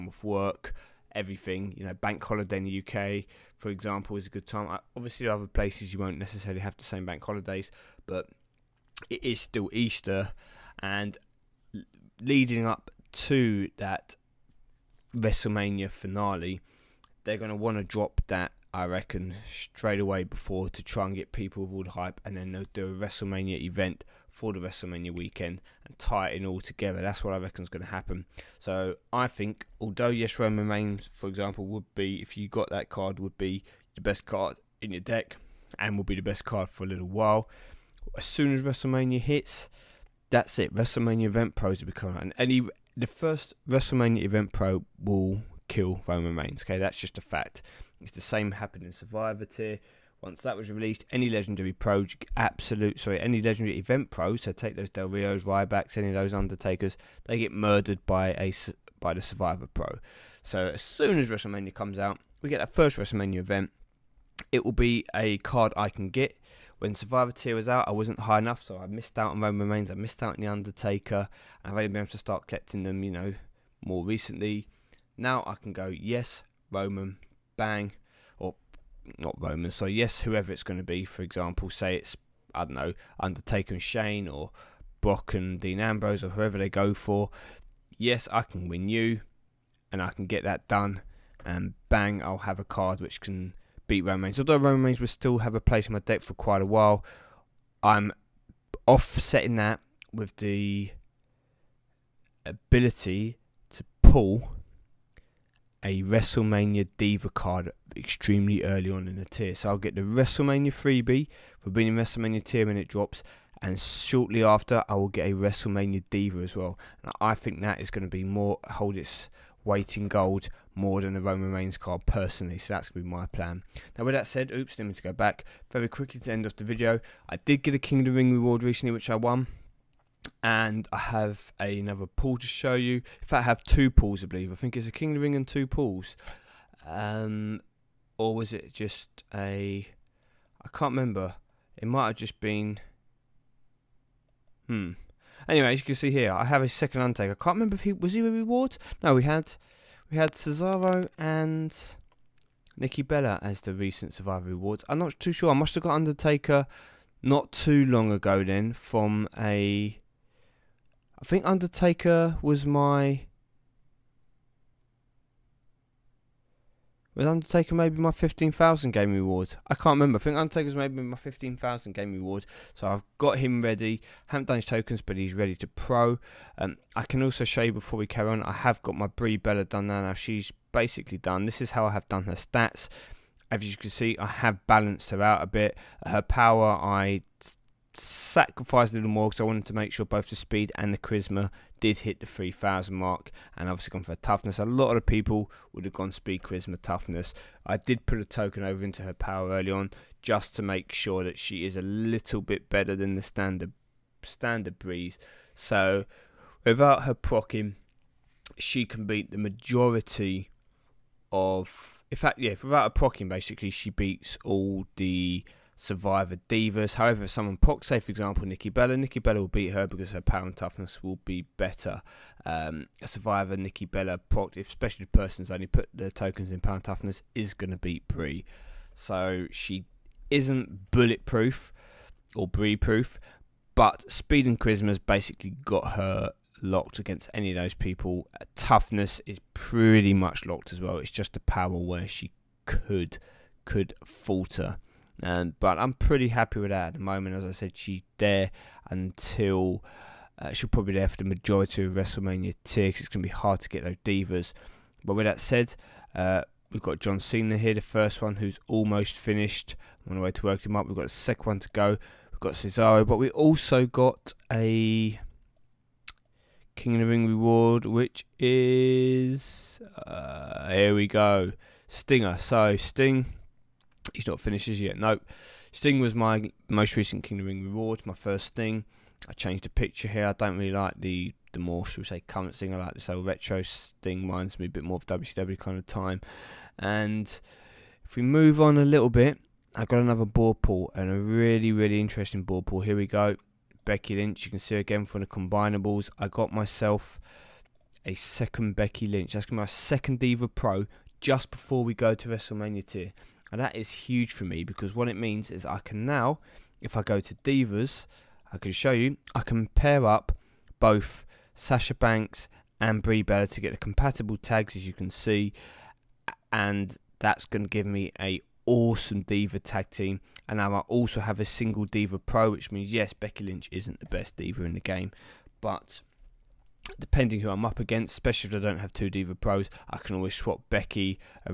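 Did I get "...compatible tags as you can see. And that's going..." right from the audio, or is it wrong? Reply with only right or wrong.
right.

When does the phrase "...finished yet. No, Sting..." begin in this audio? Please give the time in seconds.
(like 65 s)
274 s.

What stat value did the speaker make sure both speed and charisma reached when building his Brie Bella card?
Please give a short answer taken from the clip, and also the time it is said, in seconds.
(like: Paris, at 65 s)
3000, at 192 s.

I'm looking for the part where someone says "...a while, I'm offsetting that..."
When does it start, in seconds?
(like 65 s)
96 s.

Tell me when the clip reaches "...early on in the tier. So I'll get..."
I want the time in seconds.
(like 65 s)
108 s.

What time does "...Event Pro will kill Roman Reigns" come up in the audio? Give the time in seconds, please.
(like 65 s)
44 s.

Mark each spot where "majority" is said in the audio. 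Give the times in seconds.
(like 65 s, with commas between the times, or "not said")
209 s, 251 s.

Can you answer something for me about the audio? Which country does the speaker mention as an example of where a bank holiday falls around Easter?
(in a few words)
UK.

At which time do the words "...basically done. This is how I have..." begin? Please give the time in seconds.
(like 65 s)
180 s.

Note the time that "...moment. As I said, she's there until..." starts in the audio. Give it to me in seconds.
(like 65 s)
246 s.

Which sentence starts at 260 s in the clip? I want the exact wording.
We've got a second one to go.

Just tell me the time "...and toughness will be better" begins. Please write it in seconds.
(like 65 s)
220 s.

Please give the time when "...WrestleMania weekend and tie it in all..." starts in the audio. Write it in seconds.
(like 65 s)
24 s.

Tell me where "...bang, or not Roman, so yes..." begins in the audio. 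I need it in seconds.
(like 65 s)
77 s.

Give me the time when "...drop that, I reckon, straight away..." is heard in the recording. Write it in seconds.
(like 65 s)
17 s.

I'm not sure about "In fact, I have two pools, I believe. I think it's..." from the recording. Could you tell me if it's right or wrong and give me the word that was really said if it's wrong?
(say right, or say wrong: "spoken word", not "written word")
right.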